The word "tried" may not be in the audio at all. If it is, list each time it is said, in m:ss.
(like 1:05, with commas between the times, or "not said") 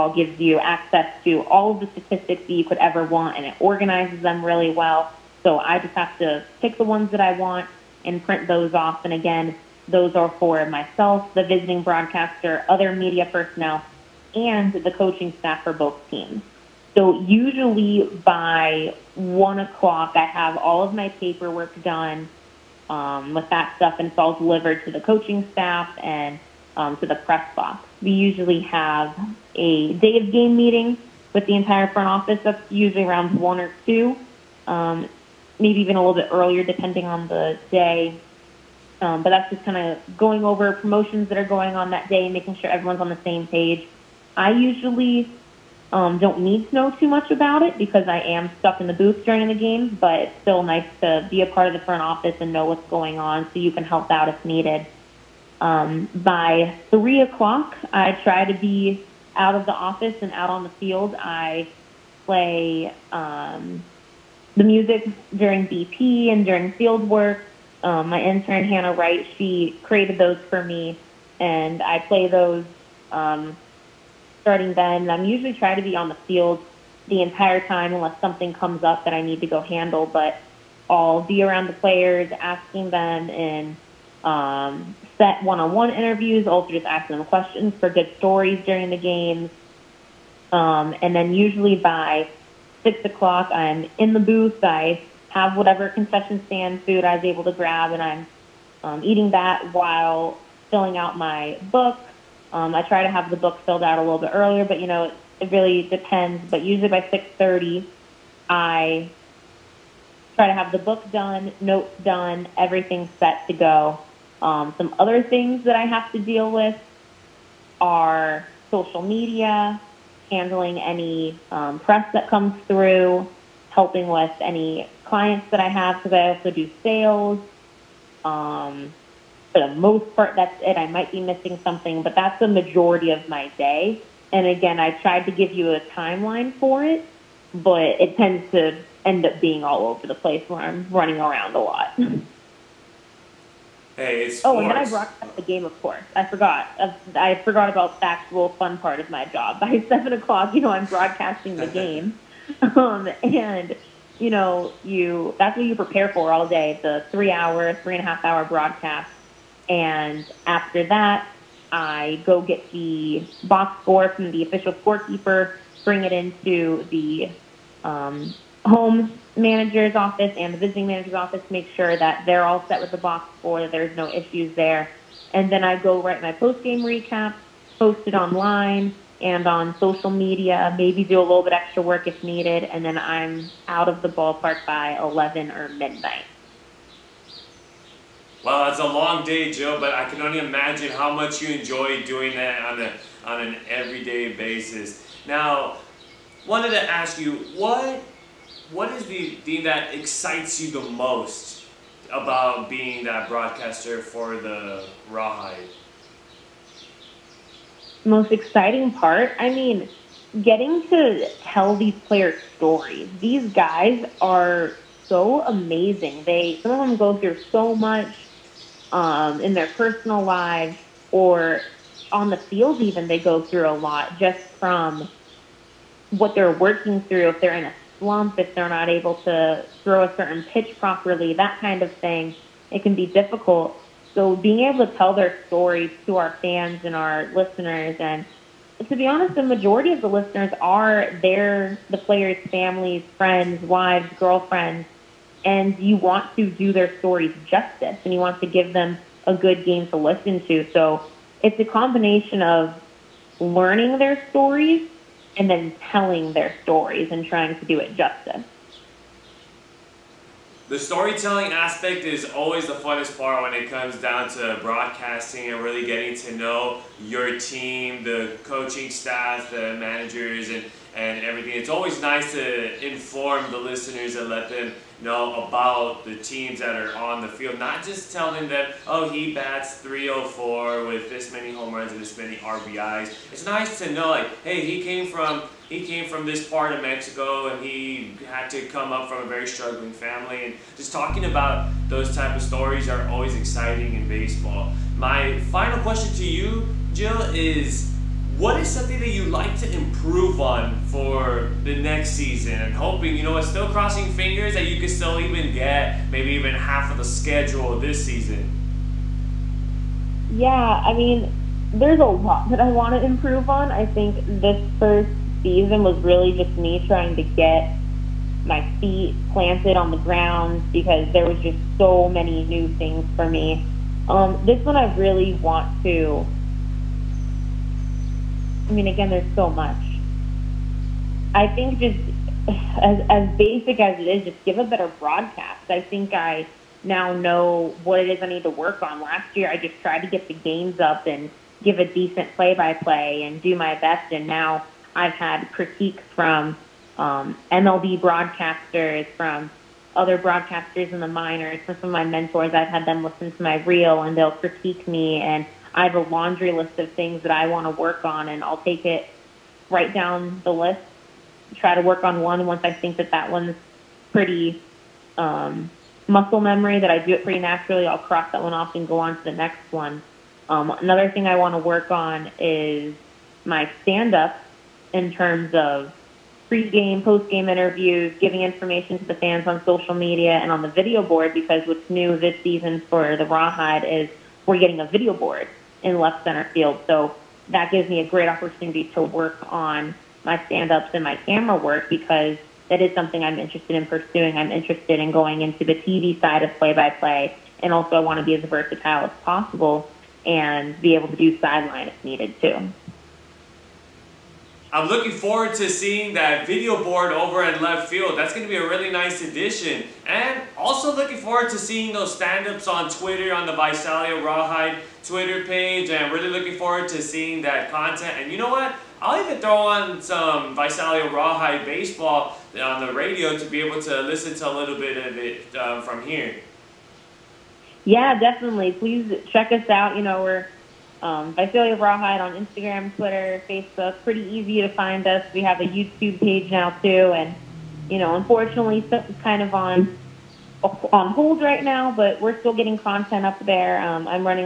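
2:15, 5:39.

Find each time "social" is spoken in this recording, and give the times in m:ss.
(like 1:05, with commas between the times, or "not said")
1:58, 2:59, 6:19.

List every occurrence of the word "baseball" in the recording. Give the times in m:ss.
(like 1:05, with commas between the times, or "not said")
4:54, 7:01.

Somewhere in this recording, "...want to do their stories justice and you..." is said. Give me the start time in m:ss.
4:05.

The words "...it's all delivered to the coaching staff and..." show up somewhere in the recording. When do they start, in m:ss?
0:24.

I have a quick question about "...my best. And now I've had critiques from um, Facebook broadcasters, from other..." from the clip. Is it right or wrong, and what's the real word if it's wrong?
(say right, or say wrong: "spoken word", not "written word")
wrong: "MLB", not "Facebook".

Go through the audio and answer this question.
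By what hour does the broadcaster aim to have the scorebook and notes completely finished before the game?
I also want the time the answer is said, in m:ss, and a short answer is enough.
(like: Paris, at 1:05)
6:30, at 1:47.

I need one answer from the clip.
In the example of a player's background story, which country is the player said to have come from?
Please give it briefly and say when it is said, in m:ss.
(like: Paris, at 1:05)
Mexico, at 4:46.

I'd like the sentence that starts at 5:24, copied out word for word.
Um, this one I really want to I mean, again, there's so much.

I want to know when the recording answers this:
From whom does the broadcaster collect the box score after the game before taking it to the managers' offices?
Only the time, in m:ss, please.
2:44.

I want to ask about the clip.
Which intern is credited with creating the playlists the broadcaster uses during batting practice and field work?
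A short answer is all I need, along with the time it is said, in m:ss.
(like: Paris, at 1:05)
Hannah Wright, at 1:08.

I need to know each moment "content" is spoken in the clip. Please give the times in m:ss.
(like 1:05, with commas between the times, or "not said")
6:57, 7:22.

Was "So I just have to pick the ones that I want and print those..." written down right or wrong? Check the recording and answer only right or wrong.
right.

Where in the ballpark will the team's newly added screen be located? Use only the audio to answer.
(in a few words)
Left center field.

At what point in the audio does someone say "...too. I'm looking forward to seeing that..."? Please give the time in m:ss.
6:42.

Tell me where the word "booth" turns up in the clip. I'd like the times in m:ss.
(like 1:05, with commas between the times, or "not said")
0:48, 1:34.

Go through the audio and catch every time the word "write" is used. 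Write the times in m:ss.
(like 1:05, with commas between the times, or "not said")
2:56, 5:59.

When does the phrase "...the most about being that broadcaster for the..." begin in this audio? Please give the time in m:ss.
3:20.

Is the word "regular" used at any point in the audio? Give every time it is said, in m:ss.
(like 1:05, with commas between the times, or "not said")
not said.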